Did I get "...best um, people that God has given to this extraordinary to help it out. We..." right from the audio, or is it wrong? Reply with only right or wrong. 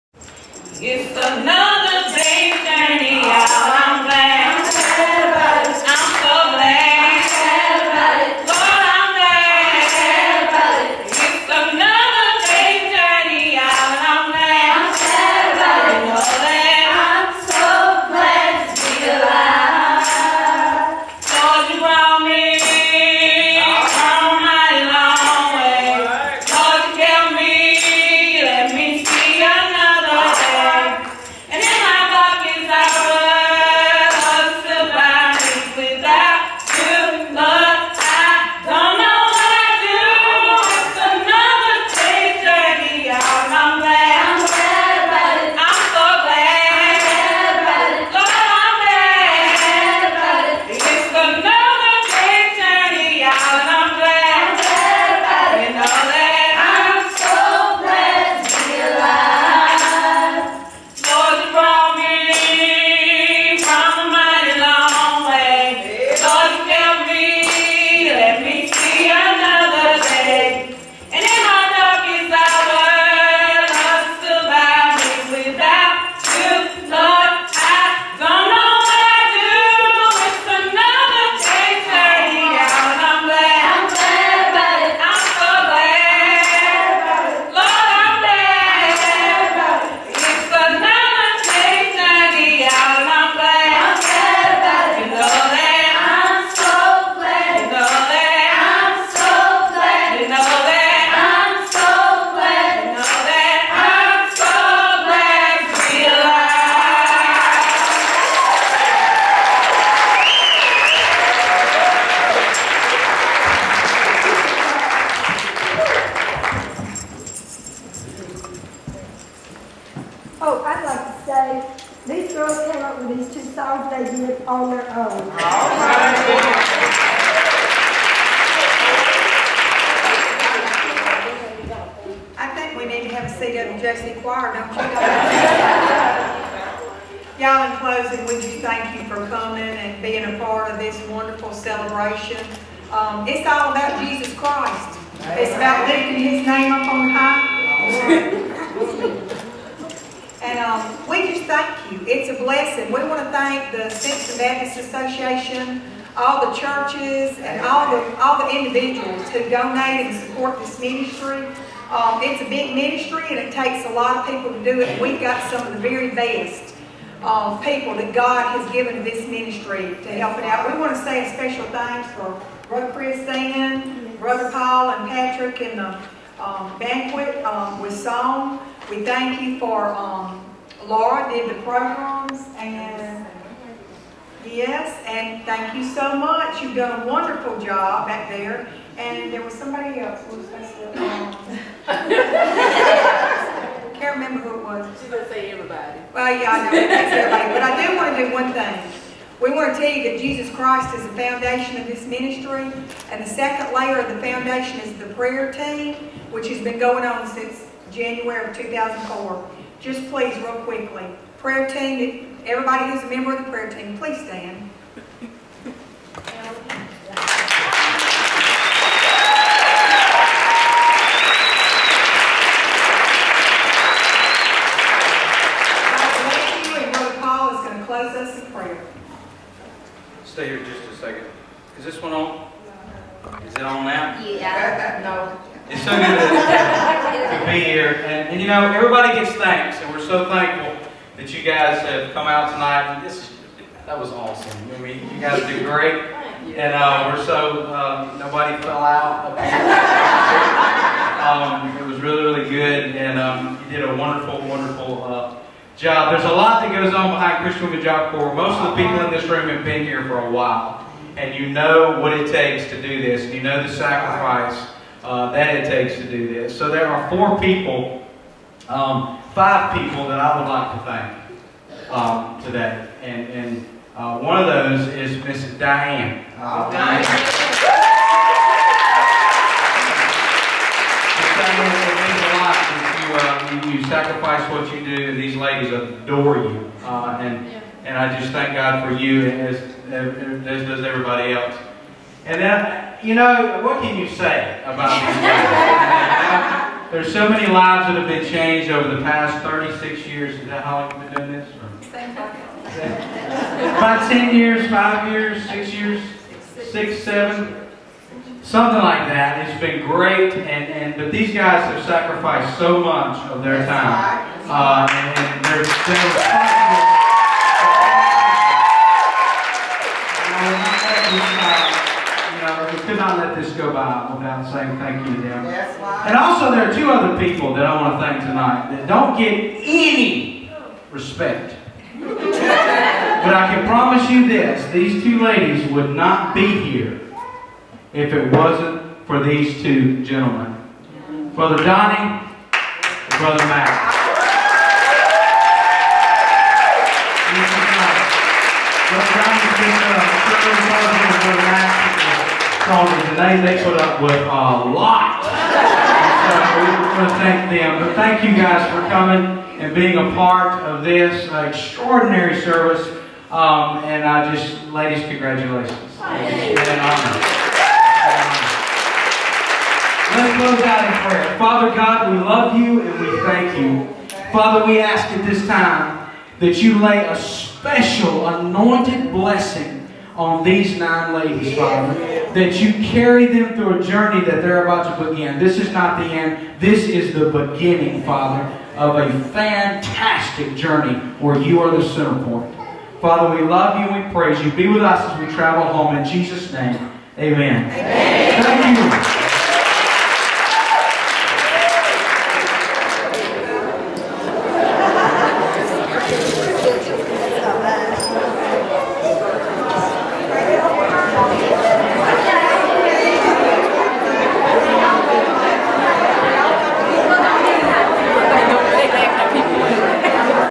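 wrong.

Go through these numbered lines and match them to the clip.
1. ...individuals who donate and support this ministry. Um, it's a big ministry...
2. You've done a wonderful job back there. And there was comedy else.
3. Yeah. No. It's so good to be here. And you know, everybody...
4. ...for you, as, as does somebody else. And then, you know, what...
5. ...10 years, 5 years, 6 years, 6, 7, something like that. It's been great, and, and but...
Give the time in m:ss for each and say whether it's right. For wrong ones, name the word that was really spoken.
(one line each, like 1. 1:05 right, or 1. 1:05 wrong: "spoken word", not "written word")
1. 2:38 right
2. 3:06 wrong: "somebody", not "comedy"
3. 3:54 right
4. 4:48 wrong: "everybody", not "somebody"
5. 5:04 right.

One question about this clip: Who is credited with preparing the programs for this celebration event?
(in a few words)
Laura.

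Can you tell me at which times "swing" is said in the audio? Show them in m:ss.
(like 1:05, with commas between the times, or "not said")
not said.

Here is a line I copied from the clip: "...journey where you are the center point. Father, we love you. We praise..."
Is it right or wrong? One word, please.
right.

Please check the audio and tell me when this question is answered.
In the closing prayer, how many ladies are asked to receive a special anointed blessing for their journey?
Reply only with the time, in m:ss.
6:20.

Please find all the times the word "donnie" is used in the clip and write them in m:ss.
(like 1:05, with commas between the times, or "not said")
5:41, 5:50.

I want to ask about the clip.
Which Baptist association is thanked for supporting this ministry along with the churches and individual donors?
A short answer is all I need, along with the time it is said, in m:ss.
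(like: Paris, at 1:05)
Simpson Baptist Association, at 2:33.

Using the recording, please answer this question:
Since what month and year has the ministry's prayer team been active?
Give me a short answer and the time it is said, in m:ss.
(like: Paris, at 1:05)
January 2004, at 3:27.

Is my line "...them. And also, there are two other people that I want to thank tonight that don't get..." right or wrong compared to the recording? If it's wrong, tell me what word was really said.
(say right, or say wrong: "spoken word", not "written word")
right.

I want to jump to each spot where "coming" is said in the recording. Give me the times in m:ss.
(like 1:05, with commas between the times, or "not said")
2:19, 5:58.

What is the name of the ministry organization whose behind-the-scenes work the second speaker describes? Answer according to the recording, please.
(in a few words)
Christian Women Job Corps.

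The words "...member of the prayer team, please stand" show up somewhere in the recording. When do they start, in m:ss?
3:33.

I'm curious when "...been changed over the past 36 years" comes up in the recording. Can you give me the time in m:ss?
4:58.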